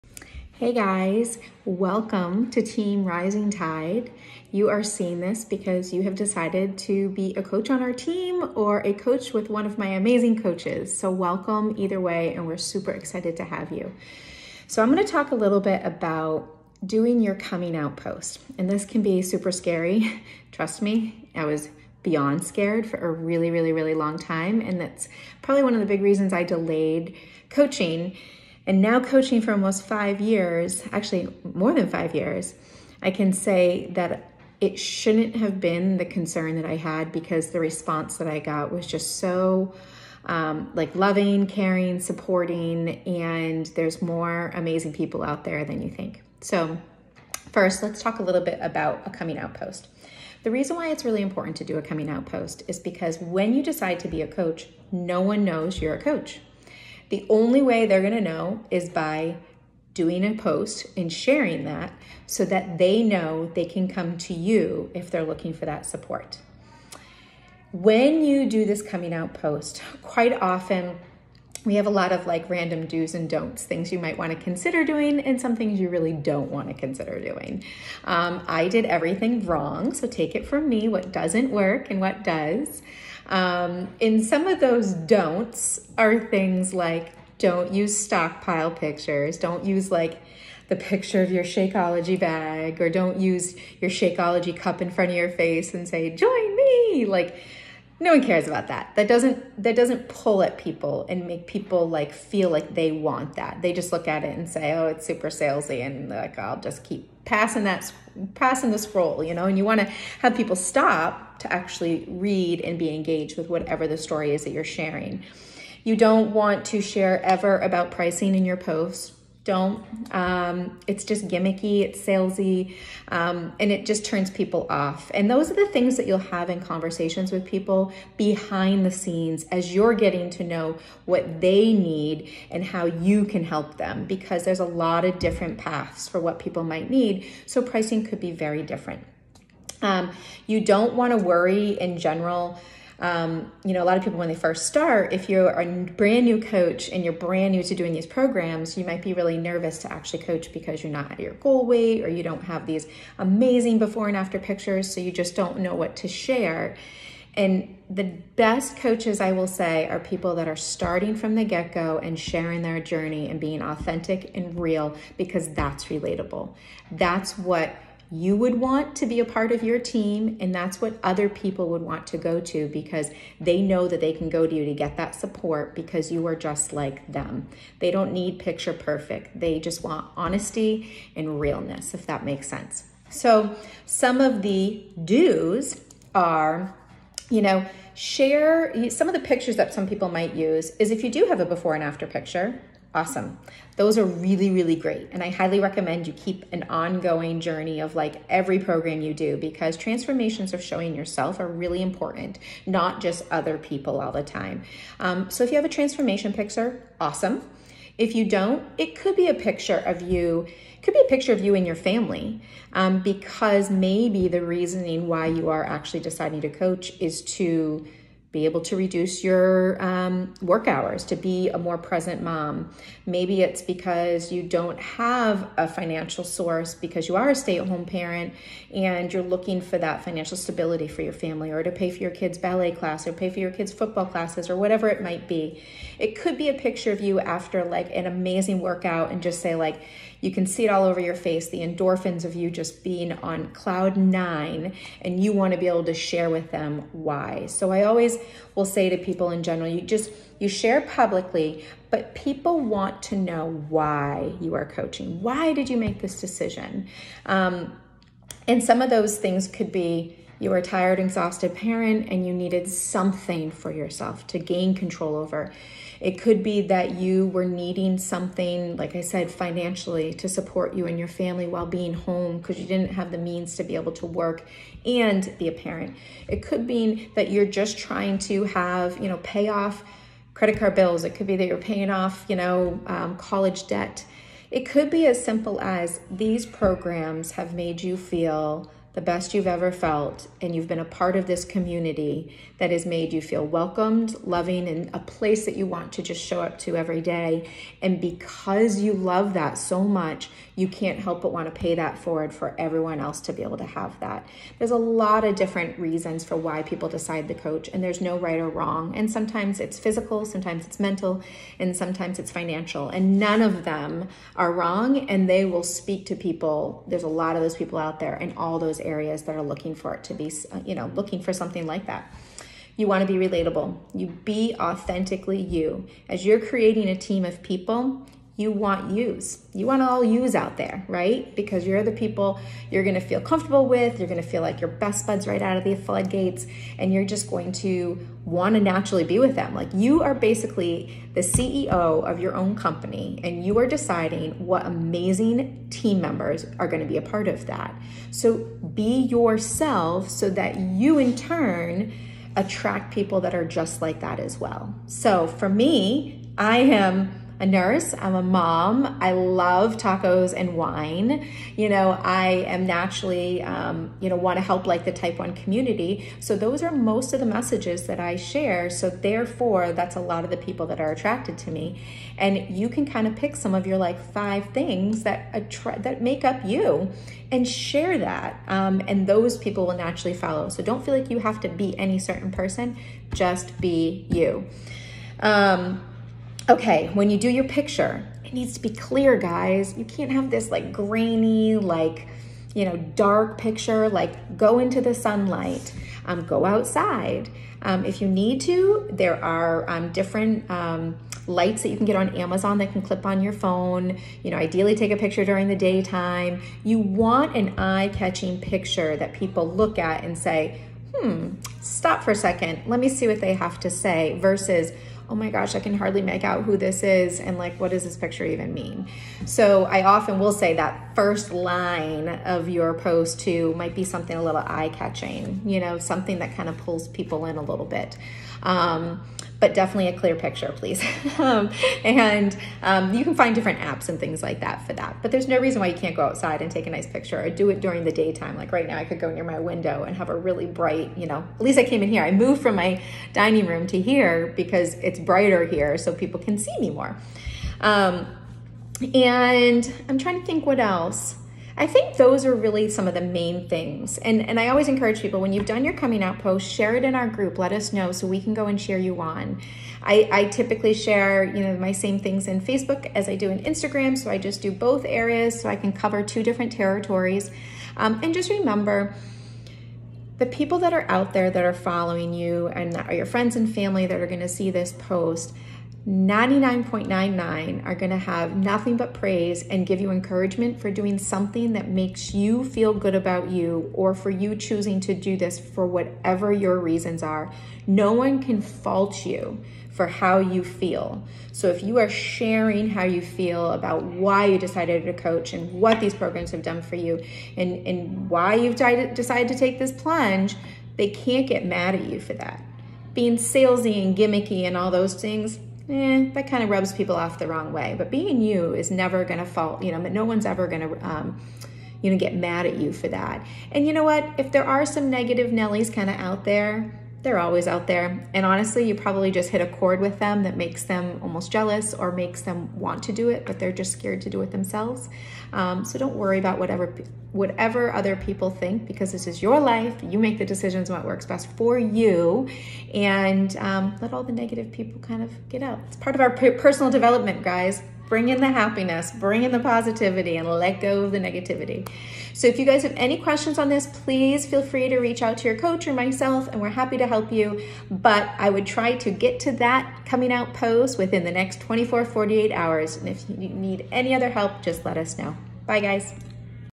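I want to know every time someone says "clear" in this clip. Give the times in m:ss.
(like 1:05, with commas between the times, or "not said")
6:28, 7:09.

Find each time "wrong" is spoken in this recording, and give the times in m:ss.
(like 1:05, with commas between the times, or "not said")
1:19, 5:08, 5:14, 8:27.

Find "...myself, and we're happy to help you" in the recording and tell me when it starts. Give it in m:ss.
9:05.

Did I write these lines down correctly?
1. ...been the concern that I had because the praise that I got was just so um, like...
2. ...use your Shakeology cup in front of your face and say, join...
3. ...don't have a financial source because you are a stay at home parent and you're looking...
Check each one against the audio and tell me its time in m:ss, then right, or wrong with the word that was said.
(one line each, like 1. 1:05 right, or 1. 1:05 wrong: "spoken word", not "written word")
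1. 0:35 wrong: "response", not "praise"
2. 1:33 right
3. 3:44 right.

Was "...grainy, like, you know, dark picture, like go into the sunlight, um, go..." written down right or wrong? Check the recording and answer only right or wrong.
right.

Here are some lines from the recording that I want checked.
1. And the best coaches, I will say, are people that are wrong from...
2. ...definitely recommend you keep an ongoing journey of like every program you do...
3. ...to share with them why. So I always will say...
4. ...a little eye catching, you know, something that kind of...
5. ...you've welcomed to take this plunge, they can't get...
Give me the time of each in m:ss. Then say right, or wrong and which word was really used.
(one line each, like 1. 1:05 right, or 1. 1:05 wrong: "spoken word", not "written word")
1. 2:37 wrong: "starting", not "wrong"
2. 3:15 wrong: "highly", not "definitely"
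3. 4:05 right
4. 7:04 right
5. 8:18 wrong: "decided", not "welcomed".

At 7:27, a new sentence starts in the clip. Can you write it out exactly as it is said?
Um, and I'm trying to think what else.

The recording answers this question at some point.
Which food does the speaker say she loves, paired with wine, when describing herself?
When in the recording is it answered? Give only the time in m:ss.
5:59.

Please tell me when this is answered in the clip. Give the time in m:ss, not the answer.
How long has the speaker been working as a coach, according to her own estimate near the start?
0:31.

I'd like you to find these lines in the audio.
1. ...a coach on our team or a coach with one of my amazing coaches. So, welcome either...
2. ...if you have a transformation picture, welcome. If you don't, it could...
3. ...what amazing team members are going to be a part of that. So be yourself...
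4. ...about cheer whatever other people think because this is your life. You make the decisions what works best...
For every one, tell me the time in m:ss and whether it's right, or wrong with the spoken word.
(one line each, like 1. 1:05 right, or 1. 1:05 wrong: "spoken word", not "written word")
1. 0:07 right
2. 3:25 wrong: "awesome", not "welcome"
3. 5:44 right
4. 8:46 wrong: "whatever", not "cheer".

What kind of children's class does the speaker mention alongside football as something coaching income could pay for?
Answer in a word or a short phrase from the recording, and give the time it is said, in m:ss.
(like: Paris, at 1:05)
ballet, at 3:52.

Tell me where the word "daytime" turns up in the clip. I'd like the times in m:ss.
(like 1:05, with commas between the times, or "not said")
6:45, 7:17.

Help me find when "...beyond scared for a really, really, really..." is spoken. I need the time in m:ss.
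0:22.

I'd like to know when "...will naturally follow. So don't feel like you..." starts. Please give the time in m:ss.
6:19.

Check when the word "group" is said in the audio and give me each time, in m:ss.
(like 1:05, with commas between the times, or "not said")
7:37.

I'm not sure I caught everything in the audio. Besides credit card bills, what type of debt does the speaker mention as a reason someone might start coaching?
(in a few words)
college debt.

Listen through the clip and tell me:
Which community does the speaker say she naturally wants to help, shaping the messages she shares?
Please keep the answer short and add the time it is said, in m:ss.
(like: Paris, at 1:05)
type 1 community, at 6:04.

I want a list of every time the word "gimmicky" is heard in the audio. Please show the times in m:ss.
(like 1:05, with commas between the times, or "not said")
2:01, 8:23.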